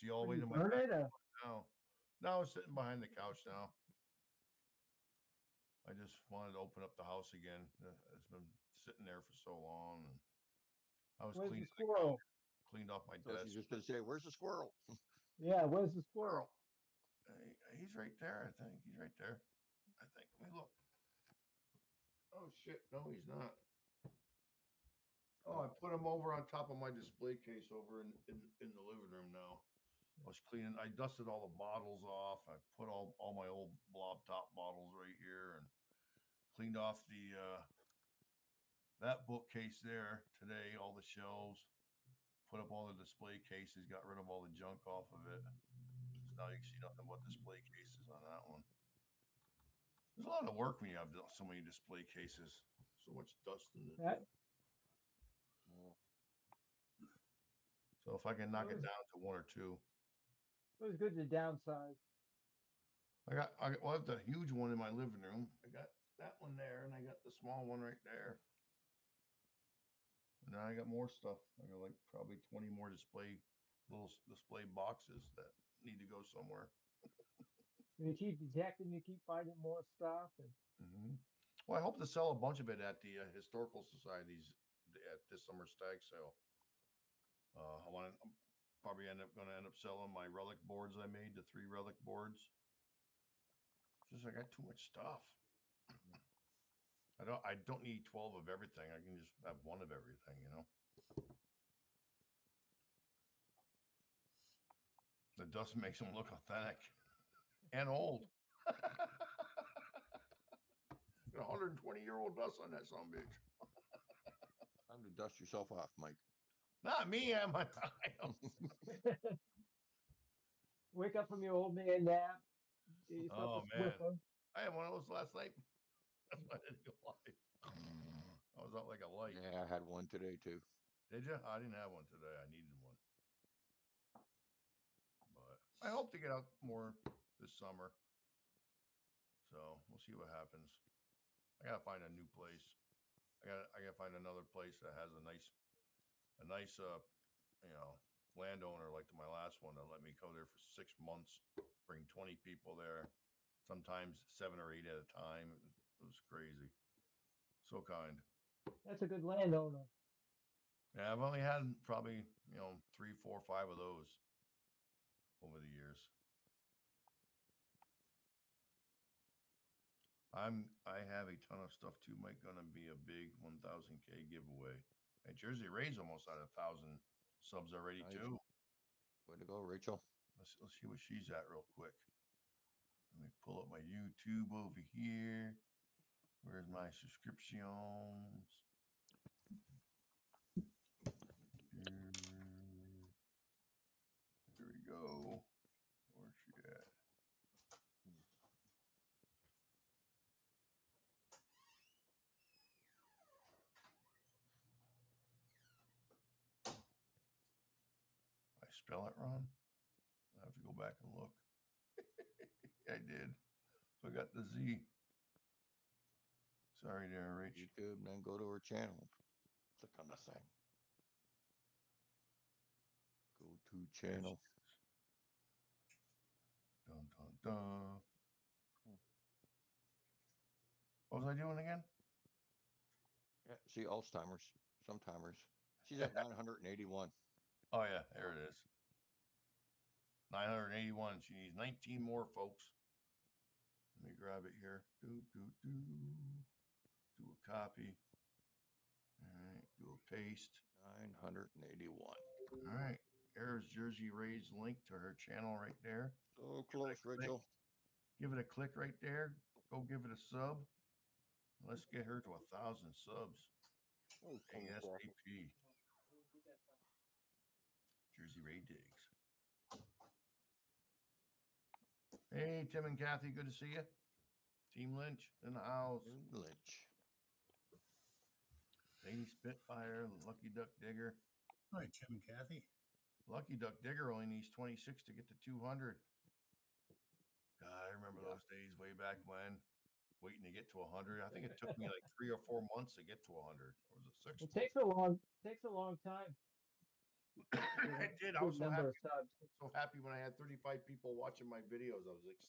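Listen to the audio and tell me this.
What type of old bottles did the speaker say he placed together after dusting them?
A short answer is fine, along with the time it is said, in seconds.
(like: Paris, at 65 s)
blob top bottles, at 33 s.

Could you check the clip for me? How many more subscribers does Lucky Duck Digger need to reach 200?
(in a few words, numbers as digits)
26.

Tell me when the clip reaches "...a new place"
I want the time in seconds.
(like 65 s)
142 s.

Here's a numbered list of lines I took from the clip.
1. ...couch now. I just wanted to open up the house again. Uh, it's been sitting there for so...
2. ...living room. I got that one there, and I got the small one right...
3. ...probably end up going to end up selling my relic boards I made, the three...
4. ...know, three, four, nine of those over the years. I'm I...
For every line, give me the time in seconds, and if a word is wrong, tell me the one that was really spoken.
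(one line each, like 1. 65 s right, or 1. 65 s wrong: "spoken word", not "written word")
1. 3 s right
2. 64 s right
3. 88 s right
4. 162 s wrong: "five", not "nine".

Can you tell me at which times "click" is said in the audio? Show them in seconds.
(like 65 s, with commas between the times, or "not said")
219 s, 258 s.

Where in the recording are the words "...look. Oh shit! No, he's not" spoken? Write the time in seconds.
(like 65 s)
20 s.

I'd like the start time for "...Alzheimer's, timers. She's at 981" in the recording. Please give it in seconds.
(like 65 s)
233 s.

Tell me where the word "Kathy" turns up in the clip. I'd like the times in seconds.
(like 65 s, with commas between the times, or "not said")
272 s, 282 s.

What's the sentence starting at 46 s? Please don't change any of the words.
So now you can see nothing but display cases on that one.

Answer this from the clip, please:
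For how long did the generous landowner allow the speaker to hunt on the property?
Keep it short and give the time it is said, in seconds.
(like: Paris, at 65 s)
6 months, at 150 s.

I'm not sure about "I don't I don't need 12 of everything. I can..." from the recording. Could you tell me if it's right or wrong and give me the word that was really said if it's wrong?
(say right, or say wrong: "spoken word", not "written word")
right.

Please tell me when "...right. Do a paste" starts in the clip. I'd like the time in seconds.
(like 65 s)
249 s.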